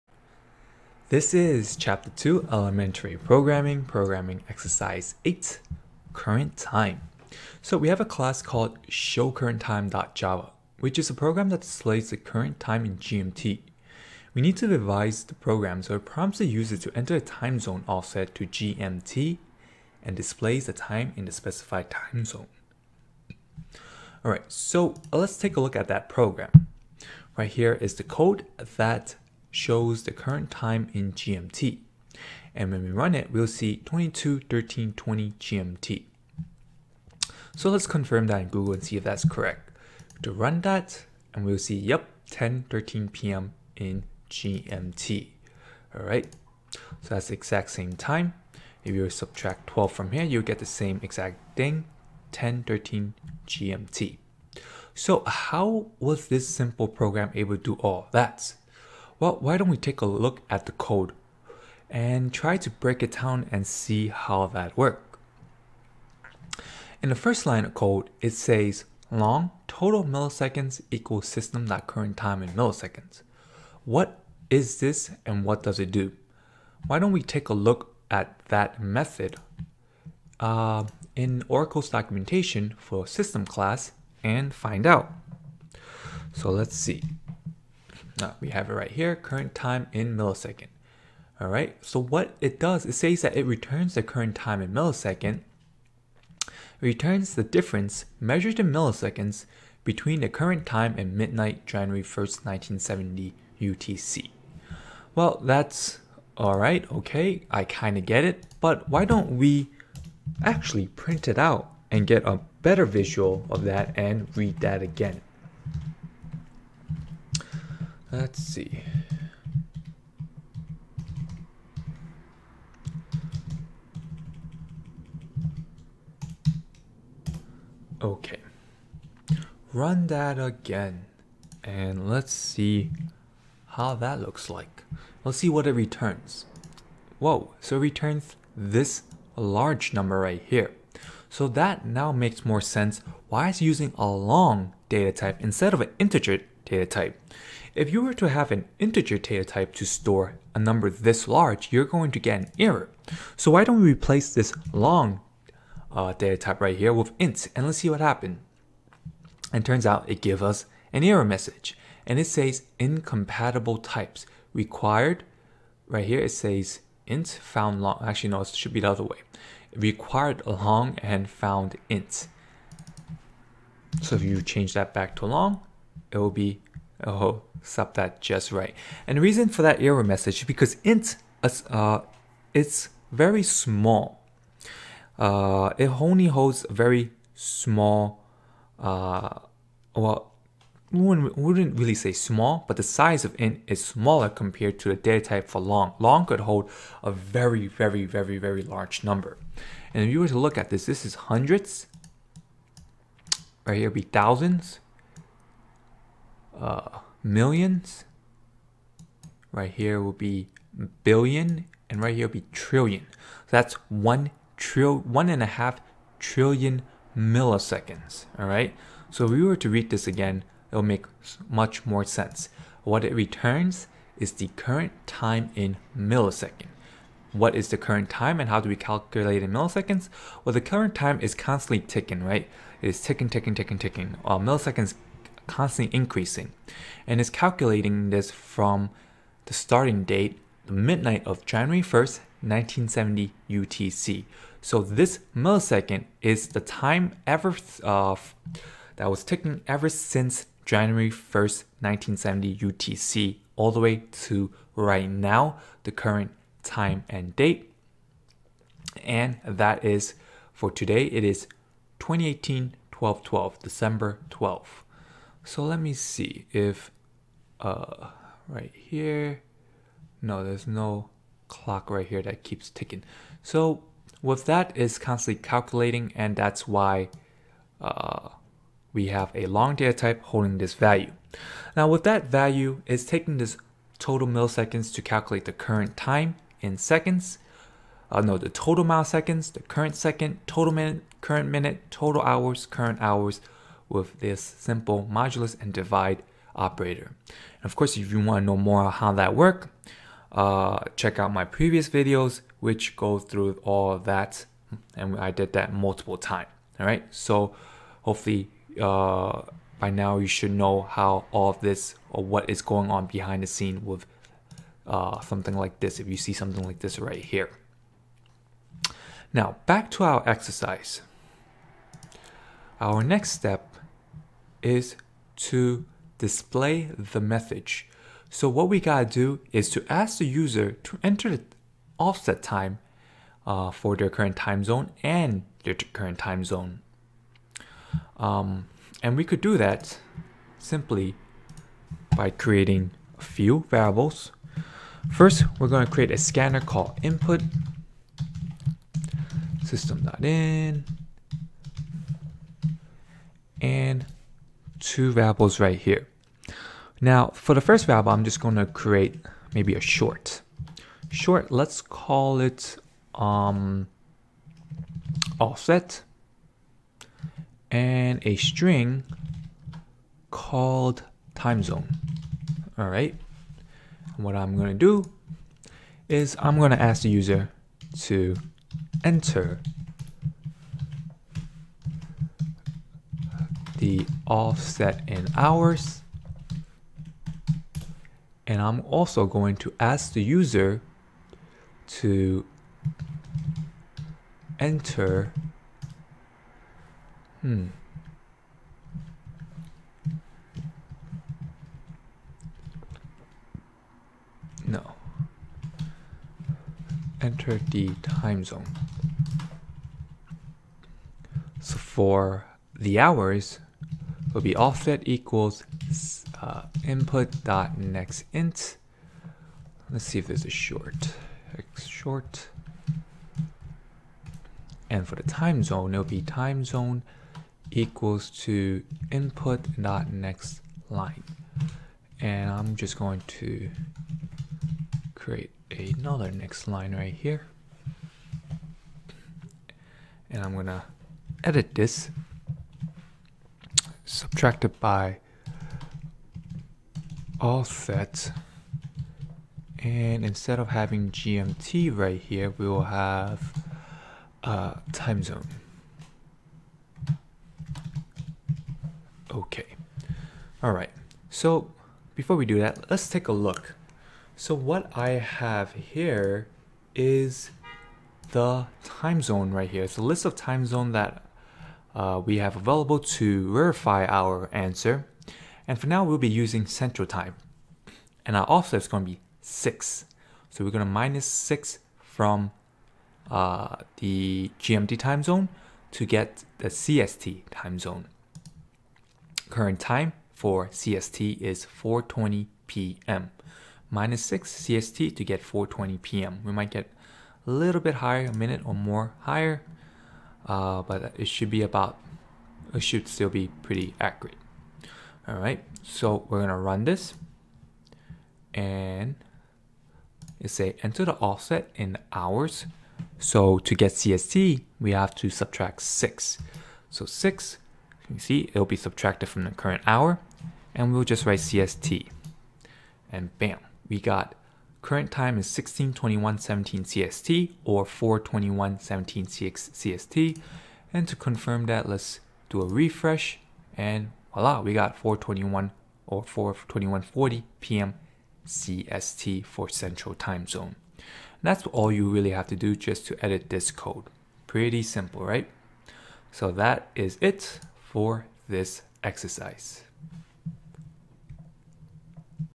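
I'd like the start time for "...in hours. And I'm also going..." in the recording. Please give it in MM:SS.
06:25.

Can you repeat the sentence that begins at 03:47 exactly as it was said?
What is the current time and how do we calculate in milliseconds?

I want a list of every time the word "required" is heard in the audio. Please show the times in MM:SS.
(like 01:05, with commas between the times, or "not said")
02:44, 02:49.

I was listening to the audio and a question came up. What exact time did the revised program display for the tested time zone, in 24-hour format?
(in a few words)
16:21:17.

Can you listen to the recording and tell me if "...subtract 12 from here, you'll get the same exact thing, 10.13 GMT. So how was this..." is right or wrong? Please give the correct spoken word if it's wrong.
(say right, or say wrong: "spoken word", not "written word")
right.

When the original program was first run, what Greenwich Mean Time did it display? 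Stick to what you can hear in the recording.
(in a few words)
22.13.20.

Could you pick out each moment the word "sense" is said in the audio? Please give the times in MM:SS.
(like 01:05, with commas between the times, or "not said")
02:22, 03:42.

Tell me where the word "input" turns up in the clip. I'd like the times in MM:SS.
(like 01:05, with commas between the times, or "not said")
05:47, 06:56, 07:09.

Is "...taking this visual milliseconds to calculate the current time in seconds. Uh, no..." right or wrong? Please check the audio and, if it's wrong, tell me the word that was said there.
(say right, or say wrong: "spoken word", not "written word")
wrong: "total", not "visual".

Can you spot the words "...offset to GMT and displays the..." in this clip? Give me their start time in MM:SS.
00:17.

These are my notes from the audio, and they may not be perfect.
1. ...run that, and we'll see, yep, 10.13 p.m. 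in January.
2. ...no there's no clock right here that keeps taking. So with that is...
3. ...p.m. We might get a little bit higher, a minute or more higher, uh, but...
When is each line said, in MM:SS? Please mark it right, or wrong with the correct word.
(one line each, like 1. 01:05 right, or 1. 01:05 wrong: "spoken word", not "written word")
1. 00:40 wrong: "GMT", not "January"
2. 04:30 wrong: "ticking", not "taking"
3. 08:16 right.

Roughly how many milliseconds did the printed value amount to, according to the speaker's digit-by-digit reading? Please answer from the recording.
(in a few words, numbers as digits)
1.5 trillion.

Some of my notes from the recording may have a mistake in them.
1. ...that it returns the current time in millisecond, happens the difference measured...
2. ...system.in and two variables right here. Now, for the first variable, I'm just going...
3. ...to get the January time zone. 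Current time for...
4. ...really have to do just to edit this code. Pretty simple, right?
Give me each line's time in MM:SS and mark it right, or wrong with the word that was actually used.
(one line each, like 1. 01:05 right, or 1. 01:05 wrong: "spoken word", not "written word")
1. 01:33 wrong: "returns", not "happens"
2. 05:49 right
3. 08:05 wrong: "CST", not "January"
4. 09:02 right.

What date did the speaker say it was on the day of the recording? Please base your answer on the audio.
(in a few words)
December 12th, 2018.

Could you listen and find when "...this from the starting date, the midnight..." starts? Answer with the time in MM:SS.
03:58.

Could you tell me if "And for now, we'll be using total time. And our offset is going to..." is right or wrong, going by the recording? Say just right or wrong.
wrong.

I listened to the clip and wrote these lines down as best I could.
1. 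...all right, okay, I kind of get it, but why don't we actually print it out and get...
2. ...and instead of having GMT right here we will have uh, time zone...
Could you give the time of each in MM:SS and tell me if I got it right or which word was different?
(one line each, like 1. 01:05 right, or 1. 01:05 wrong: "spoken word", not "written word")
1. 01:46 right
2. 07:29 right.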